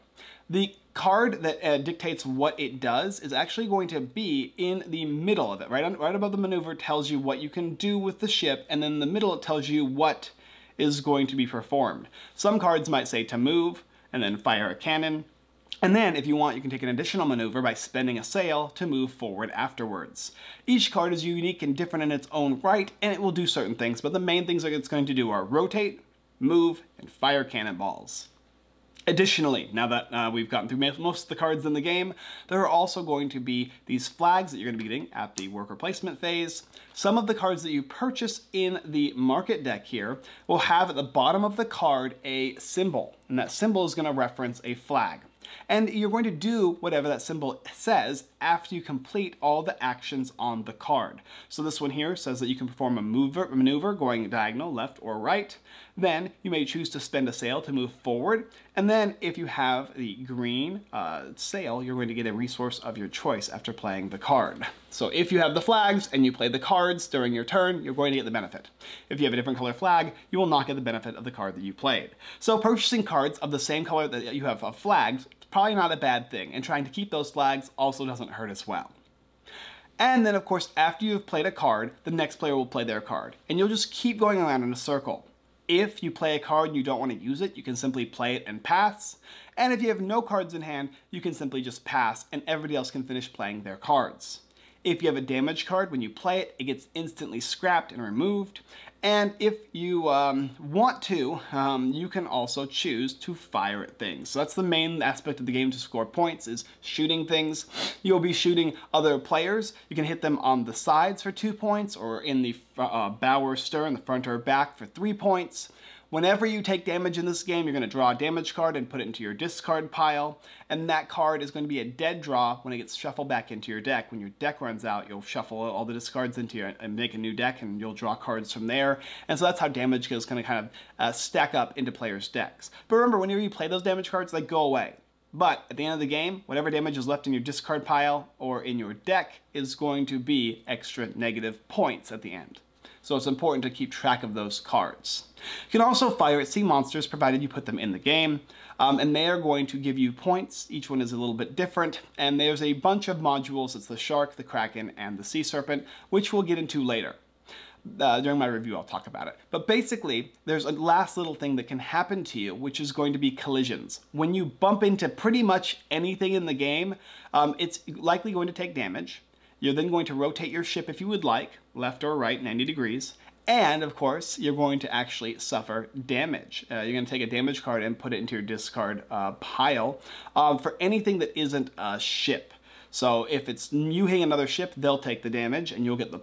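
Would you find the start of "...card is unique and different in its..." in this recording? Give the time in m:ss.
0:20.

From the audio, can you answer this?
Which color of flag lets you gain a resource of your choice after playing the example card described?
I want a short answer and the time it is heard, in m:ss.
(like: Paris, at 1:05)
Green, at 1:00.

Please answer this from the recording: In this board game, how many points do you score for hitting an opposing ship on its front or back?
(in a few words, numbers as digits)
3.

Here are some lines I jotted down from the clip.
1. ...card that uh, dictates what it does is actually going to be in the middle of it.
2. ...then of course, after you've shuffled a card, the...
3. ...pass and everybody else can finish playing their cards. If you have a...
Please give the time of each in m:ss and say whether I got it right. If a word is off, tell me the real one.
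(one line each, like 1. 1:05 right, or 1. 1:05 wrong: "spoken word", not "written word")
1. 0:00 right
2. 1:20 wrong: "played", not "shuffled"
3. 1:31 right.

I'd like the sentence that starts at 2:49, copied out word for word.
You're then going to rotate your ship if you would like, left or right 90 degrees.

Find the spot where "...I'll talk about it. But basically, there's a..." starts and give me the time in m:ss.
2:38.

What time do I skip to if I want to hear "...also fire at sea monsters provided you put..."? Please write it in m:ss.
2:25.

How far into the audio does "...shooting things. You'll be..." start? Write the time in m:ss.
1:46.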